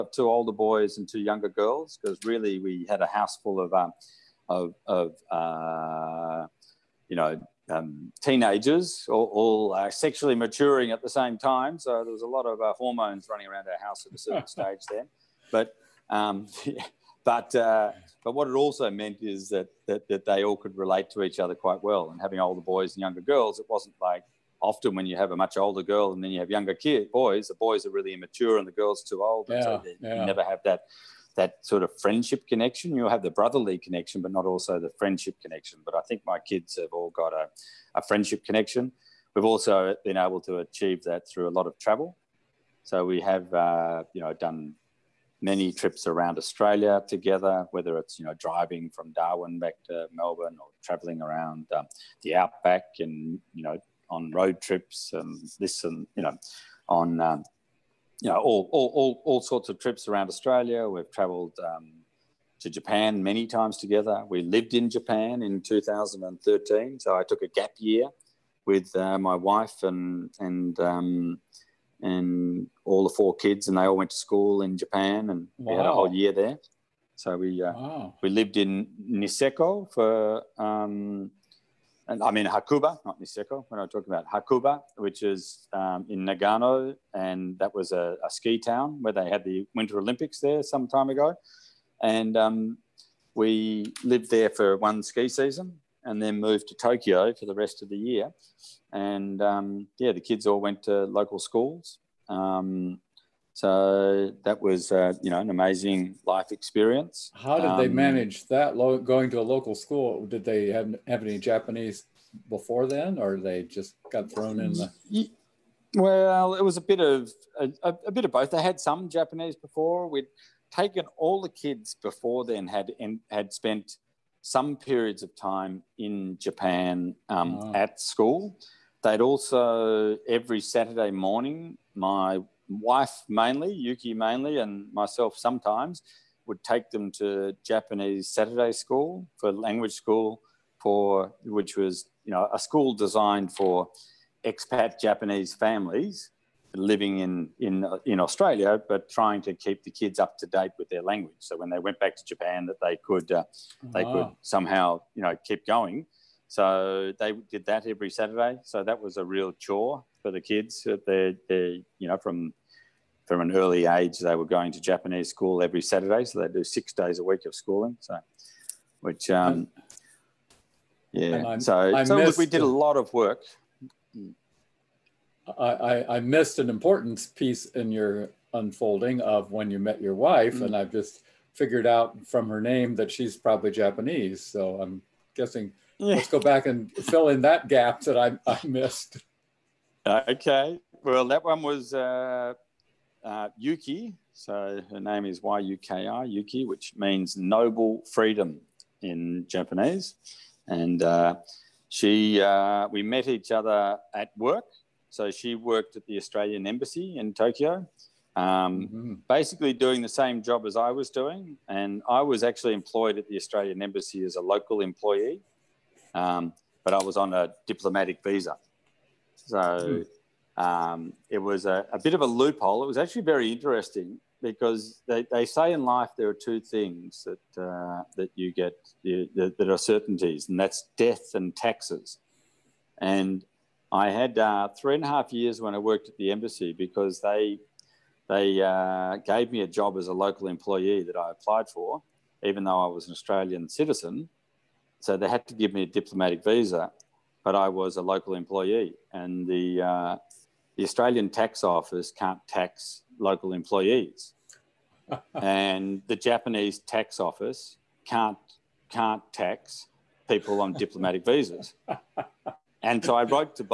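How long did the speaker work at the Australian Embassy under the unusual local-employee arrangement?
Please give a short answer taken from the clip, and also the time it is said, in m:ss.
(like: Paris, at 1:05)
Three and a half years, at 3:54.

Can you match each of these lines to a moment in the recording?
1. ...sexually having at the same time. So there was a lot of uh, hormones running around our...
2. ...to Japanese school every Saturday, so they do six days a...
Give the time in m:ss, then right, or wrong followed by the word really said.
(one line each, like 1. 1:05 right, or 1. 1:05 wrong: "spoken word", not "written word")
1. 0:09 wrong: "maturing", not "having"
2. 2:44 right.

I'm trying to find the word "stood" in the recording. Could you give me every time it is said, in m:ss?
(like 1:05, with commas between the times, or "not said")
not said.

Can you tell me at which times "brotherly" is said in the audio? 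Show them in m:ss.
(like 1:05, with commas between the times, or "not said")
0:33.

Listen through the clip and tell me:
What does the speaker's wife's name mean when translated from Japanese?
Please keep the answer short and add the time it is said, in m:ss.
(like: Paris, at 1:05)
Noble freedom, at 3:17.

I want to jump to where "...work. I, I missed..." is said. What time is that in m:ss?
2:53.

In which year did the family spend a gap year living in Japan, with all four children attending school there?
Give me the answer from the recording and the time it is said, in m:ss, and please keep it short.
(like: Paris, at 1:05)
2013, at 1:05.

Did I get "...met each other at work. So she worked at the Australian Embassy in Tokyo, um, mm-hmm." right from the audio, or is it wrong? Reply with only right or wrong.
right.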